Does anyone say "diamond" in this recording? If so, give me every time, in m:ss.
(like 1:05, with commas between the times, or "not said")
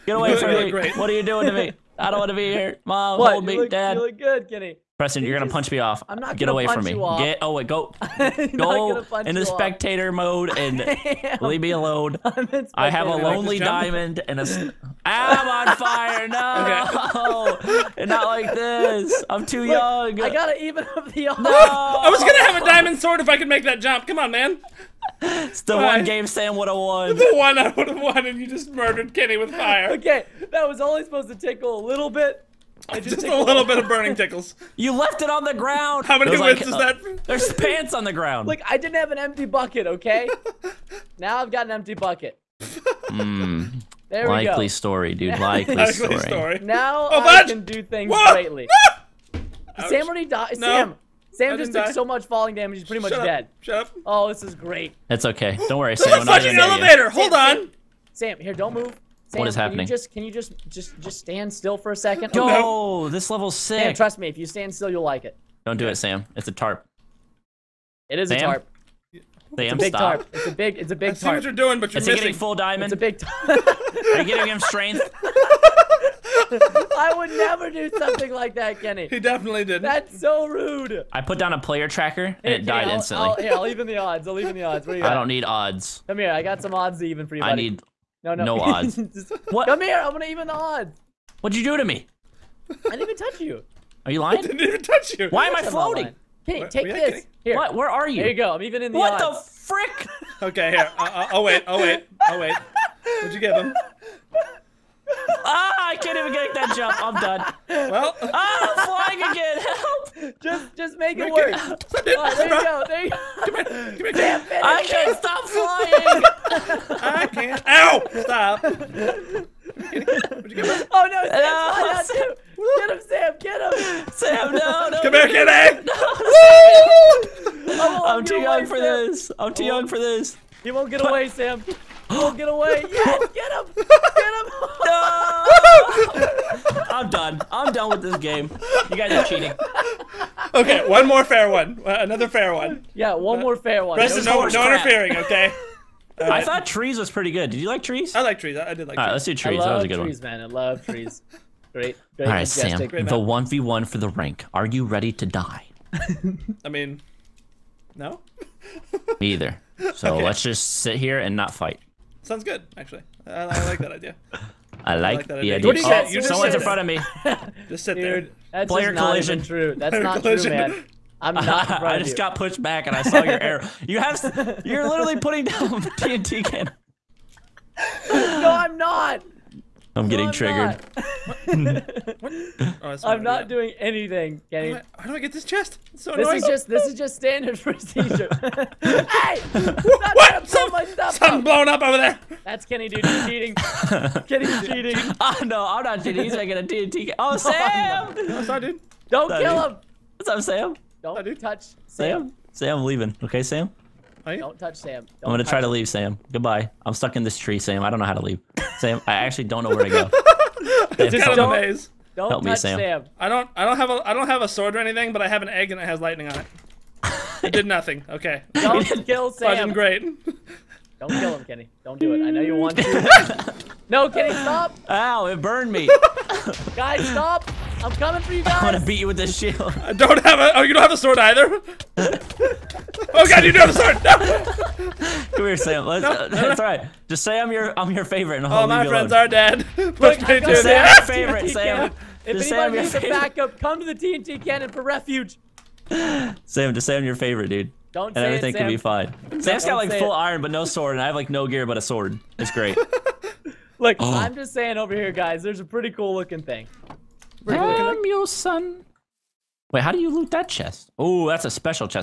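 0:13, 0:22, 1:12.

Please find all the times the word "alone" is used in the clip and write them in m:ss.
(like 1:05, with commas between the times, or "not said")
0:11, 3:59.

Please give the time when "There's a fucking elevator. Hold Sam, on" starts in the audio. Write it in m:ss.
0:56.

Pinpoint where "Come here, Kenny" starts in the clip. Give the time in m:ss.
2:05.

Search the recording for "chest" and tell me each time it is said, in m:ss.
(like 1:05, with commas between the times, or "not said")
3:05, 4:20.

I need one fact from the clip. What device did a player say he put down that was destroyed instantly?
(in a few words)
player tracker.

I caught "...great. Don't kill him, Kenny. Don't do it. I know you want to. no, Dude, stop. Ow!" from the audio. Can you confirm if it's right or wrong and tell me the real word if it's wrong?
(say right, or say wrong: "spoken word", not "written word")
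wrong: "Kenny", not "Dude".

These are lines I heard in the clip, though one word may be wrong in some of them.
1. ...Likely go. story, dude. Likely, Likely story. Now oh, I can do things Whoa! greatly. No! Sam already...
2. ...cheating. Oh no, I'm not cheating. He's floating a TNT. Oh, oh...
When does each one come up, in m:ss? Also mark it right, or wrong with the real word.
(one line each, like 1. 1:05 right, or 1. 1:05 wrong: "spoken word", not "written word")
1. 0:44 right
2. 3:14 wrong: "making", not "floating".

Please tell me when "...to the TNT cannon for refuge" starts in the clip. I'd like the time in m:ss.
4:03.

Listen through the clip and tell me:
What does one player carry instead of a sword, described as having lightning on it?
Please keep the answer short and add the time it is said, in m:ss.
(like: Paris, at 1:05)
an egg, at 3:35.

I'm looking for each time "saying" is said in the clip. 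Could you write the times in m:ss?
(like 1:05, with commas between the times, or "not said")
4:14.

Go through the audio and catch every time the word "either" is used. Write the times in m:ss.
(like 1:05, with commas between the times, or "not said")
2:39, 3:51.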